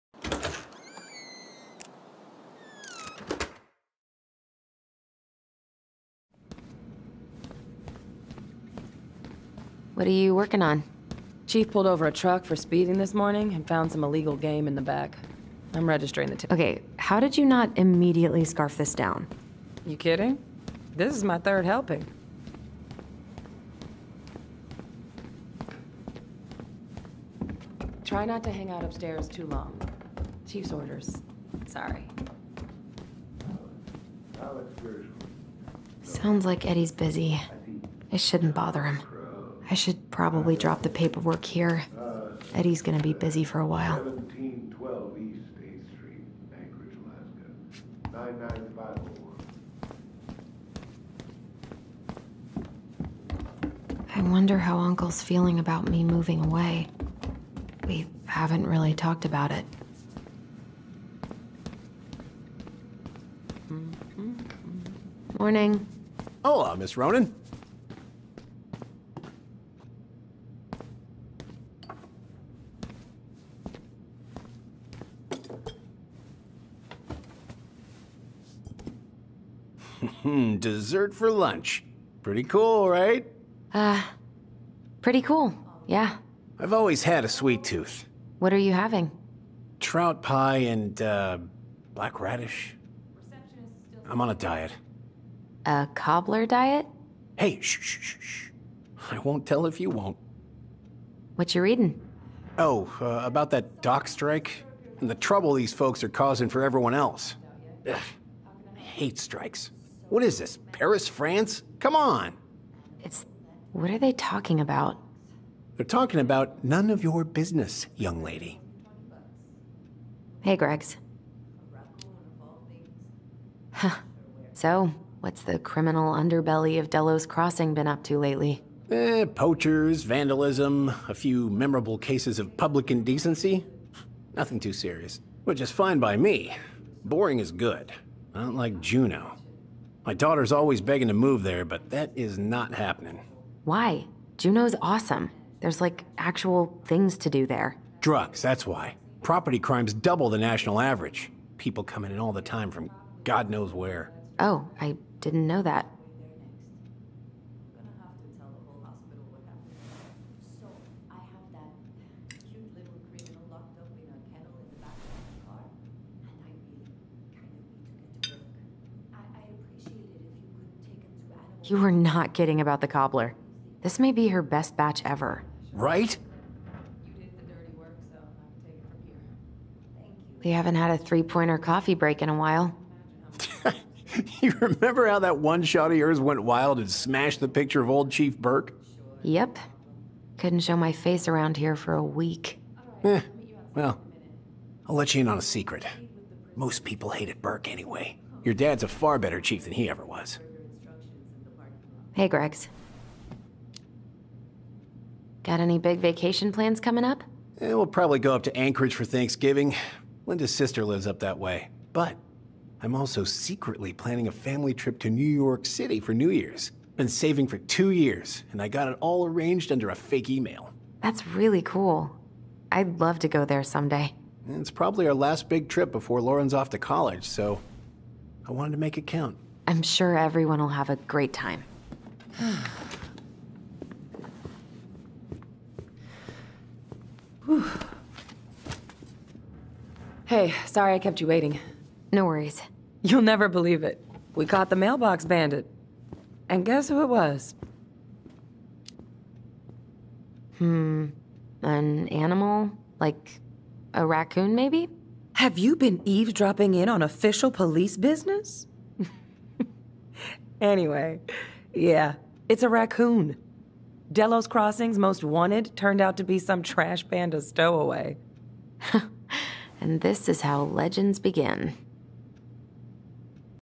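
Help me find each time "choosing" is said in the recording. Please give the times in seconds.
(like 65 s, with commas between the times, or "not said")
not said.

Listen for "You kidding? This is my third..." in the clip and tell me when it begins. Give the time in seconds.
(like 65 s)
19 s.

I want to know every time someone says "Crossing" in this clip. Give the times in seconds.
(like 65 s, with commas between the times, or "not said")
127 s, 264 s.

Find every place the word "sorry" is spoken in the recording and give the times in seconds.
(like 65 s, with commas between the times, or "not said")
31 s, 240 s.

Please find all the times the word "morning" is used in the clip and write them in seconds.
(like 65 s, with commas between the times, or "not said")
13 s, 65 s.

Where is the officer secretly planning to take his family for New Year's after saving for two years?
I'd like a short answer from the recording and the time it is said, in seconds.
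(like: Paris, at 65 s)
New York City, at 215 s.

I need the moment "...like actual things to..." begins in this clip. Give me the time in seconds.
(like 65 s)
145 s.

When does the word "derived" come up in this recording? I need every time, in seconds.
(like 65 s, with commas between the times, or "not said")
not said.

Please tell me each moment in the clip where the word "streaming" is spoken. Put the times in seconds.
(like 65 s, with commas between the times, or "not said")
not said.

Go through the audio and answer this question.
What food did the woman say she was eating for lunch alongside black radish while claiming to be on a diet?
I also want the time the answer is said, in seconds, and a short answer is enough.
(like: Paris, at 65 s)
Trout pie, at 89 s.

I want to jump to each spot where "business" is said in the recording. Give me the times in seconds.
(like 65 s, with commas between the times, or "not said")
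117 s, 257 s.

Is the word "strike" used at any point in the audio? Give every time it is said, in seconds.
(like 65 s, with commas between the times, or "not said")
104 s, 109 s.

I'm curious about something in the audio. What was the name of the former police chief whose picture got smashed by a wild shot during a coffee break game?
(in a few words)
Chief Burke.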